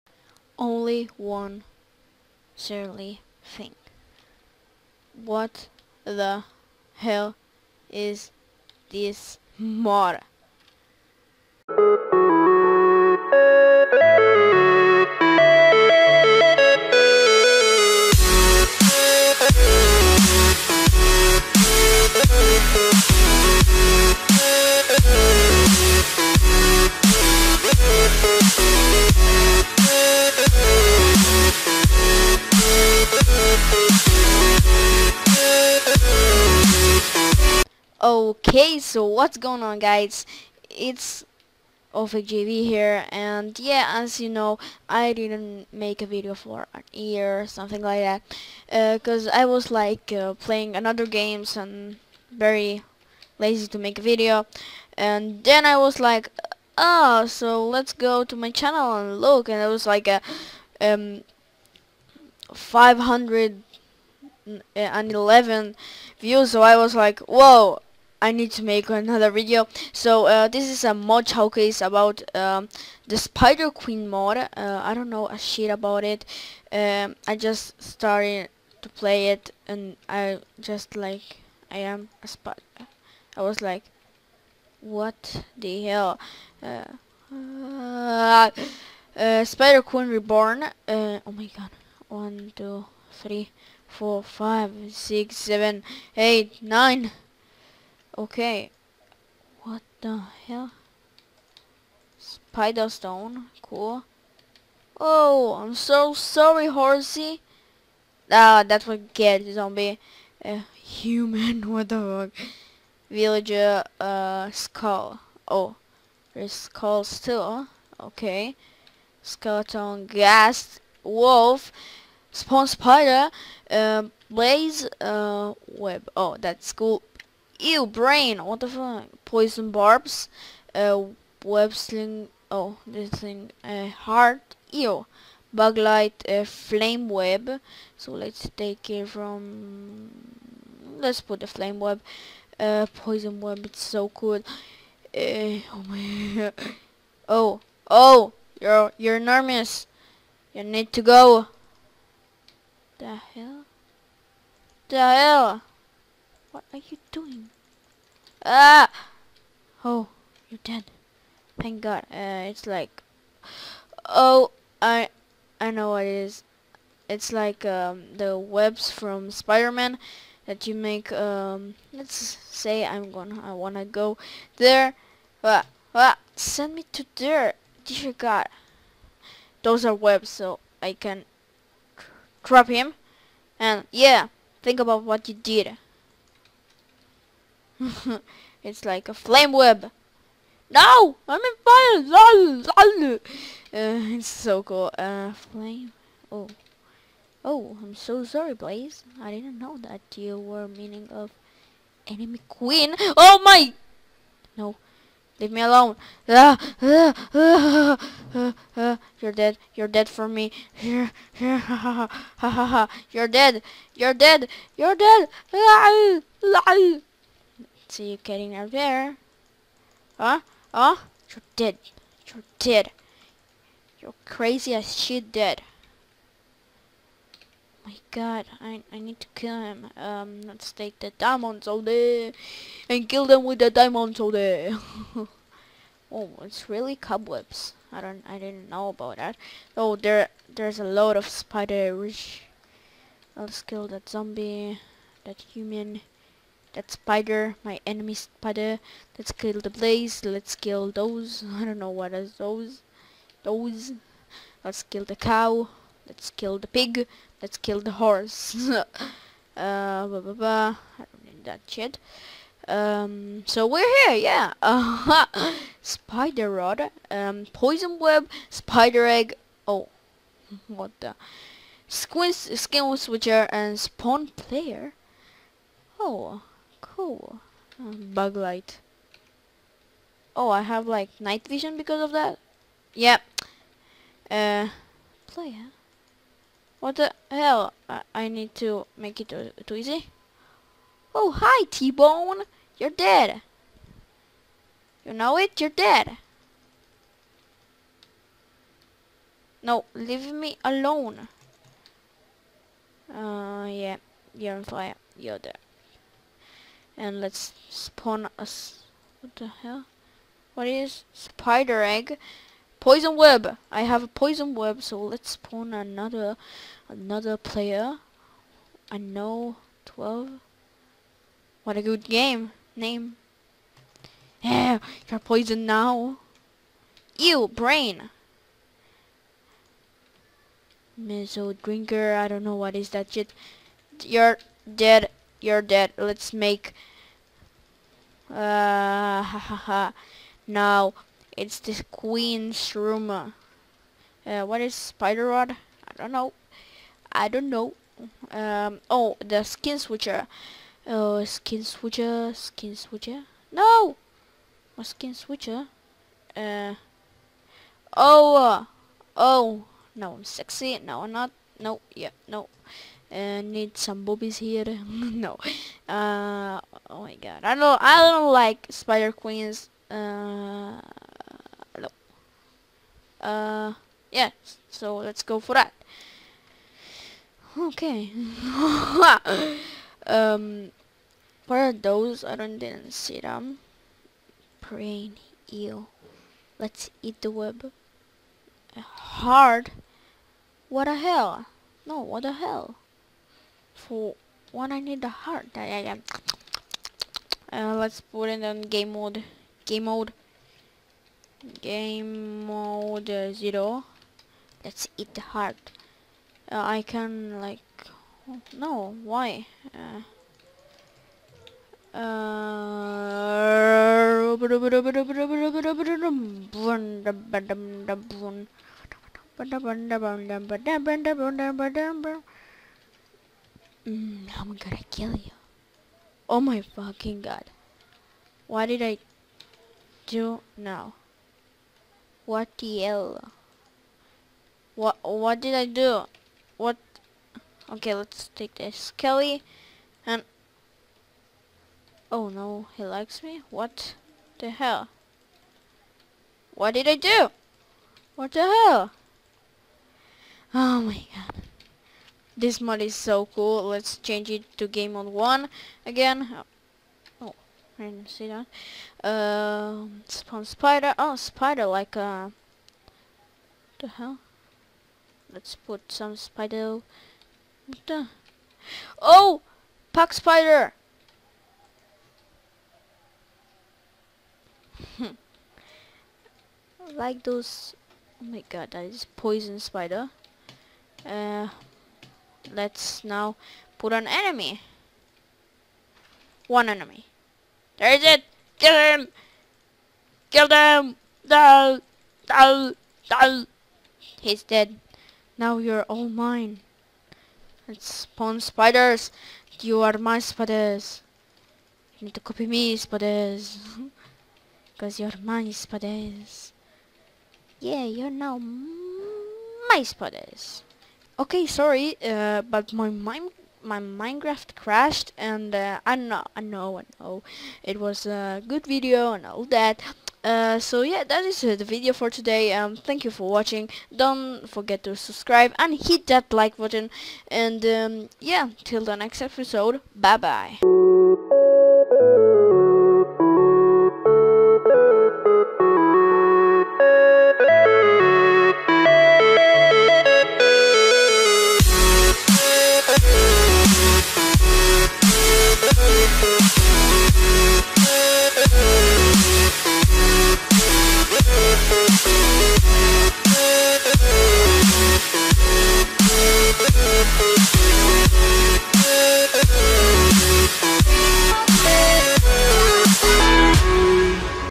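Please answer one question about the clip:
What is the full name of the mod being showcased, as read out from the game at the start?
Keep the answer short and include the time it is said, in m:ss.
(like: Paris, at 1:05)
Spider Queen Reborn, at 1:29.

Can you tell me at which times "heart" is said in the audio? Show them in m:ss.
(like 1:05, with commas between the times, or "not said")
2:13, 6:35, 6:45.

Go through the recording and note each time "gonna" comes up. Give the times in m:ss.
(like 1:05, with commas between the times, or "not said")
2:53, 7:04.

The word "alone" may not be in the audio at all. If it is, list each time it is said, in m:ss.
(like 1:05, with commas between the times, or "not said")
3:25, 5:00.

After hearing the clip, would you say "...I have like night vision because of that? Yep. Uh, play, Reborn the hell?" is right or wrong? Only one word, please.
wrong.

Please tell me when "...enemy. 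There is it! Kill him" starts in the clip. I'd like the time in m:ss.
8:06.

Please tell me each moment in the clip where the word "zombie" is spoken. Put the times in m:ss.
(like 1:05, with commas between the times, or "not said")
1:49, 4:04.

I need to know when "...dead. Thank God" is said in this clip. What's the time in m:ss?
2:40.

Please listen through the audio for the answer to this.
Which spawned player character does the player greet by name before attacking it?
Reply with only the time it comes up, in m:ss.
4:51.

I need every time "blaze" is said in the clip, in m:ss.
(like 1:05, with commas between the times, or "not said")
2:04, 3:18, 4:09.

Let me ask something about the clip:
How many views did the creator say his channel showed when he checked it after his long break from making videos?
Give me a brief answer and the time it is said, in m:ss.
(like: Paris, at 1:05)
511, at 1:02.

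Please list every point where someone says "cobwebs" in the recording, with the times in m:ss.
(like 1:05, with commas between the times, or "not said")
3:56.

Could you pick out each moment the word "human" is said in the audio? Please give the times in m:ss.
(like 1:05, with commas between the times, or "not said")
1:50, 4:05.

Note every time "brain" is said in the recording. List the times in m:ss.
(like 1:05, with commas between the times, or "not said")
2:07, 5:27, 6:24.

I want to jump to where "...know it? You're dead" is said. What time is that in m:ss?
4:55.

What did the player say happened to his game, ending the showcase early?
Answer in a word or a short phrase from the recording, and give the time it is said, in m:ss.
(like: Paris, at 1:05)
Minecraft crashed, at 8:33.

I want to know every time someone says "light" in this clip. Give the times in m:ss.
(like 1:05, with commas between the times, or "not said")
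2:15, 4:38.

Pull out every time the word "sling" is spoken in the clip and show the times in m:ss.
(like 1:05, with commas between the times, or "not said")
2:11.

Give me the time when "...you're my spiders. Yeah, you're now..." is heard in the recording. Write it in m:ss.
8:24.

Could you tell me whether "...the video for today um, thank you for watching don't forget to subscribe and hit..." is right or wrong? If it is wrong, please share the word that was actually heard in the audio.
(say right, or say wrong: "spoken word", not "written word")
right.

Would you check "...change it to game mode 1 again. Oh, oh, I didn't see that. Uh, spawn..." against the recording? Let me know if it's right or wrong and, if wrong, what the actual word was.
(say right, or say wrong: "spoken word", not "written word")
right.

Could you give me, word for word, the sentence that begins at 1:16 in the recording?
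Um, I just started to play it and I just like I am a spot.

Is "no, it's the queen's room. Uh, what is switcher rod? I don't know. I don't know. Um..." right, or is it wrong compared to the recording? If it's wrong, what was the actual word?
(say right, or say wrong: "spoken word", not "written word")
wrong: "spider", not "switcher".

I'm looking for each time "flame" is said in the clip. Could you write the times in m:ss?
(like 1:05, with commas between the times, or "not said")
2:16, 2:21, 3:09, 3:15.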